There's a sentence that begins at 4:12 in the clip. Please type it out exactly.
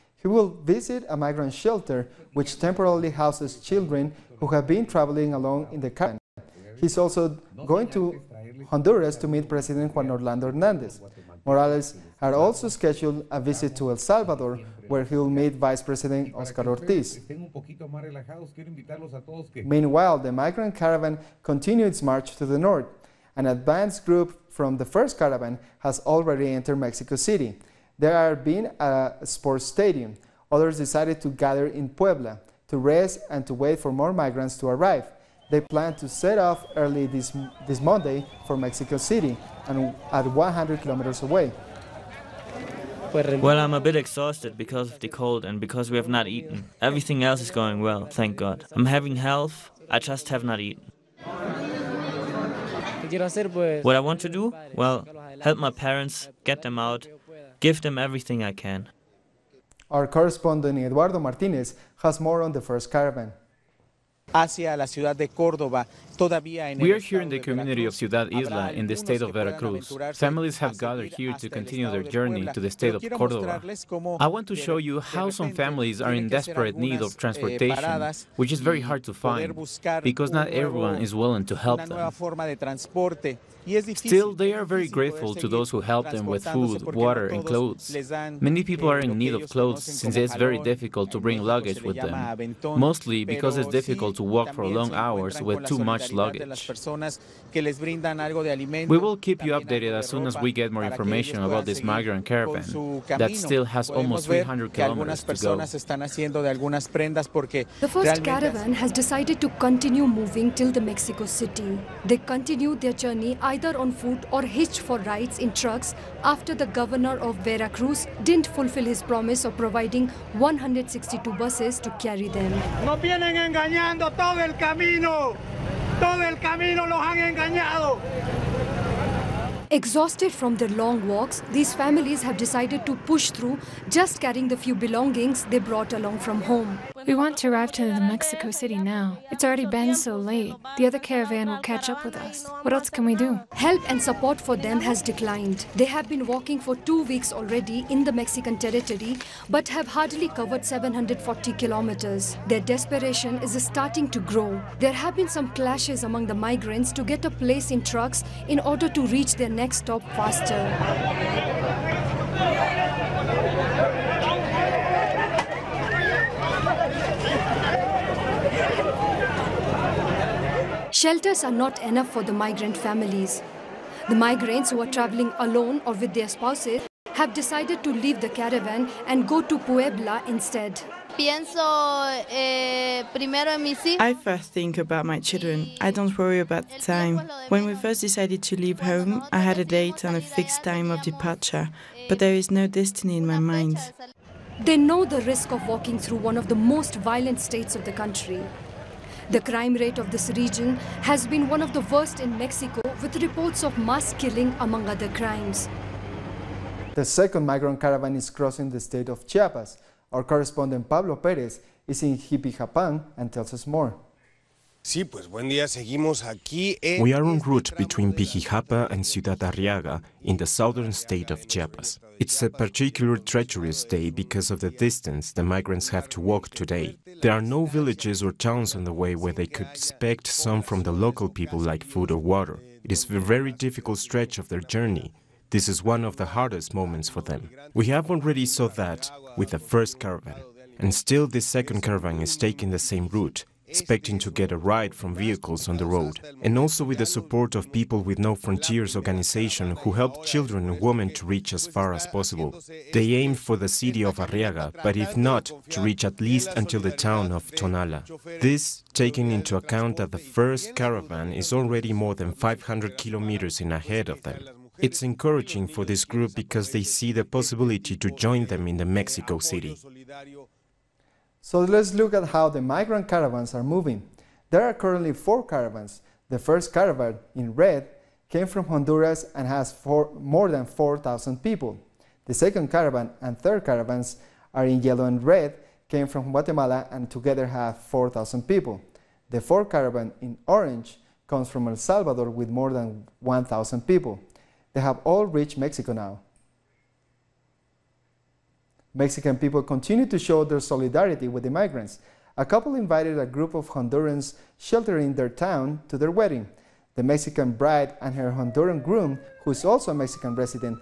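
They aimed for the city of Arriaga, but if not, to reach at least until the town of Tonala.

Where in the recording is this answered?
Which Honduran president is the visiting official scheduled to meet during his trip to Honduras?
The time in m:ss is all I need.
0:09.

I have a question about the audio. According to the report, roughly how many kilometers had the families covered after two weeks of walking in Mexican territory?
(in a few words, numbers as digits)
740.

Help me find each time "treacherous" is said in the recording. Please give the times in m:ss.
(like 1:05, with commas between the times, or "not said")
3:43.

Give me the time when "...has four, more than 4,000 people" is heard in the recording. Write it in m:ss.
4:39.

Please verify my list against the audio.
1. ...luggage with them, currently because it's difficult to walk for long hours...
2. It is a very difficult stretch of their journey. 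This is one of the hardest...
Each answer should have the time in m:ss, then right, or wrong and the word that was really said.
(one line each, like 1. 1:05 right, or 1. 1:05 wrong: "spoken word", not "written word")
1. 1:31 wrong: "mostly", not "currently"
2. 3:52 right.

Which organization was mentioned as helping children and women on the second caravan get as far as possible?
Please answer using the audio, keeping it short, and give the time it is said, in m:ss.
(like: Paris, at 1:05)
People with No Frontiers, at 4:07.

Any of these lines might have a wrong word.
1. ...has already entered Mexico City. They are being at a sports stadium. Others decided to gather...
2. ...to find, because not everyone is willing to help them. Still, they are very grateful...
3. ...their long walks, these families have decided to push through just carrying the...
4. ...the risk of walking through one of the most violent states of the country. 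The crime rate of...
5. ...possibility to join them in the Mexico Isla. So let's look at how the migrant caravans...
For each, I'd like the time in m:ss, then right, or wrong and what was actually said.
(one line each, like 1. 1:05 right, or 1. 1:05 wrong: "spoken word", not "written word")
1. 0:25 right
2. 1:19 right
3. 2:10 right
4. 3:15 right
5. 4:27 wrong: "City", not "Isla".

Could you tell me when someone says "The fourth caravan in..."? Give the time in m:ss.
4:49.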